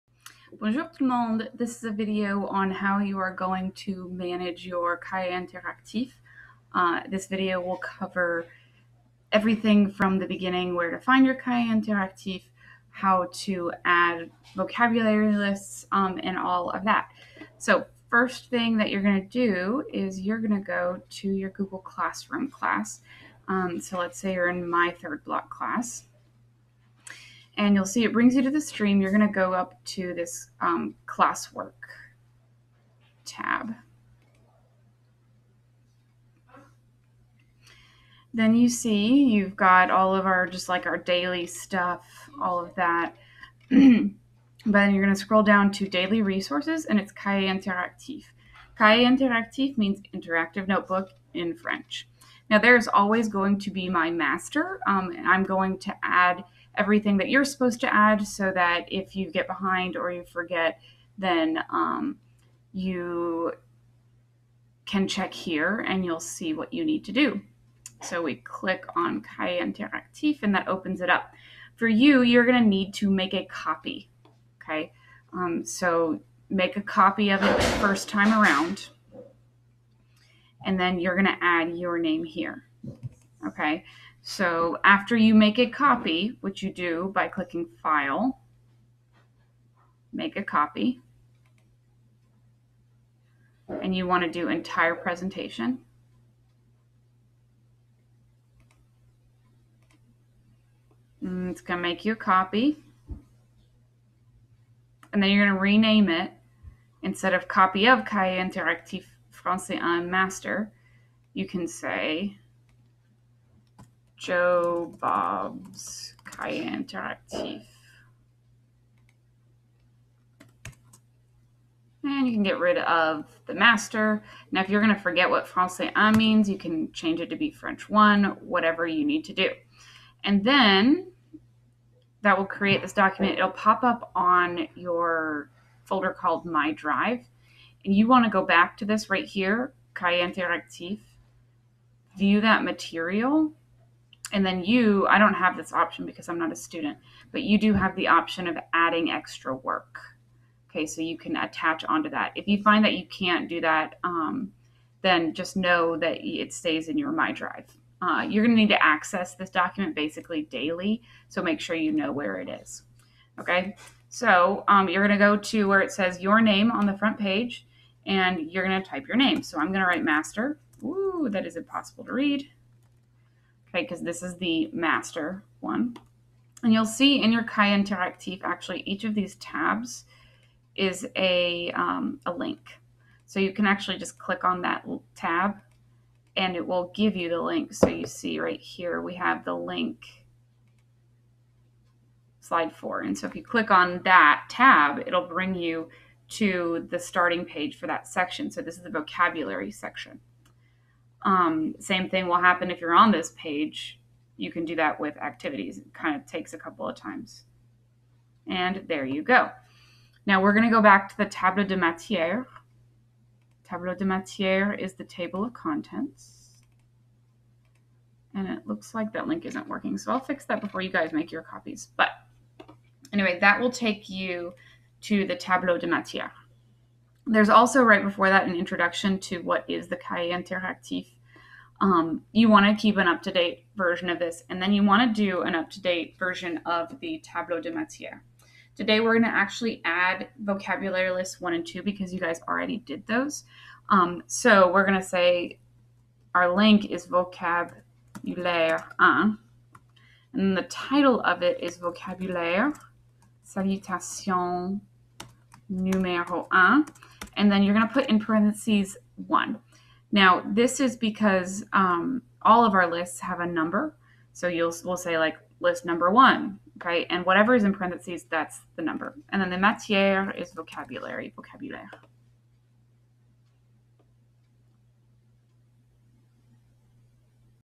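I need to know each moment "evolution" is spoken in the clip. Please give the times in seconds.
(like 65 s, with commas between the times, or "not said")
not said.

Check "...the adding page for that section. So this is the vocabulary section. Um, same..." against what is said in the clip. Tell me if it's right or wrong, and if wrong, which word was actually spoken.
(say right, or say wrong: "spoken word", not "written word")
wrong: "starting", not "adding".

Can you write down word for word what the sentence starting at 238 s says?
Today, we're going to actually add vocabulary lists one and two because you guys already did those.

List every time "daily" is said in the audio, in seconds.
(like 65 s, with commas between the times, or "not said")
40 s, 45 s, 160 s.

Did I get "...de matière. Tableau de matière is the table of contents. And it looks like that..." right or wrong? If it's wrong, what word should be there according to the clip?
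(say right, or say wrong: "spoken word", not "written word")
right.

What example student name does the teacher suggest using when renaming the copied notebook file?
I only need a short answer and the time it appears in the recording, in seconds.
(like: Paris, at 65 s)
Joe Bob, at 114 s.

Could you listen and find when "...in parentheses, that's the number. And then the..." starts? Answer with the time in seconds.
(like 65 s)
267 s.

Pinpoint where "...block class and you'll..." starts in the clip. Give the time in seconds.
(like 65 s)
25 s.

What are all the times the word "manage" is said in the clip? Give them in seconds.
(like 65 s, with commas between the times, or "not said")
4 s.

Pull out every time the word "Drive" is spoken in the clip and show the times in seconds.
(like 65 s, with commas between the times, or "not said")
136 s, 157 s.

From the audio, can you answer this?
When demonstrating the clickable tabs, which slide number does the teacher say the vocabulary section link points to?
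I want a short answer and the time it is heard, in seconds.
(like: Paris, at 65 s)
4, at 192 s.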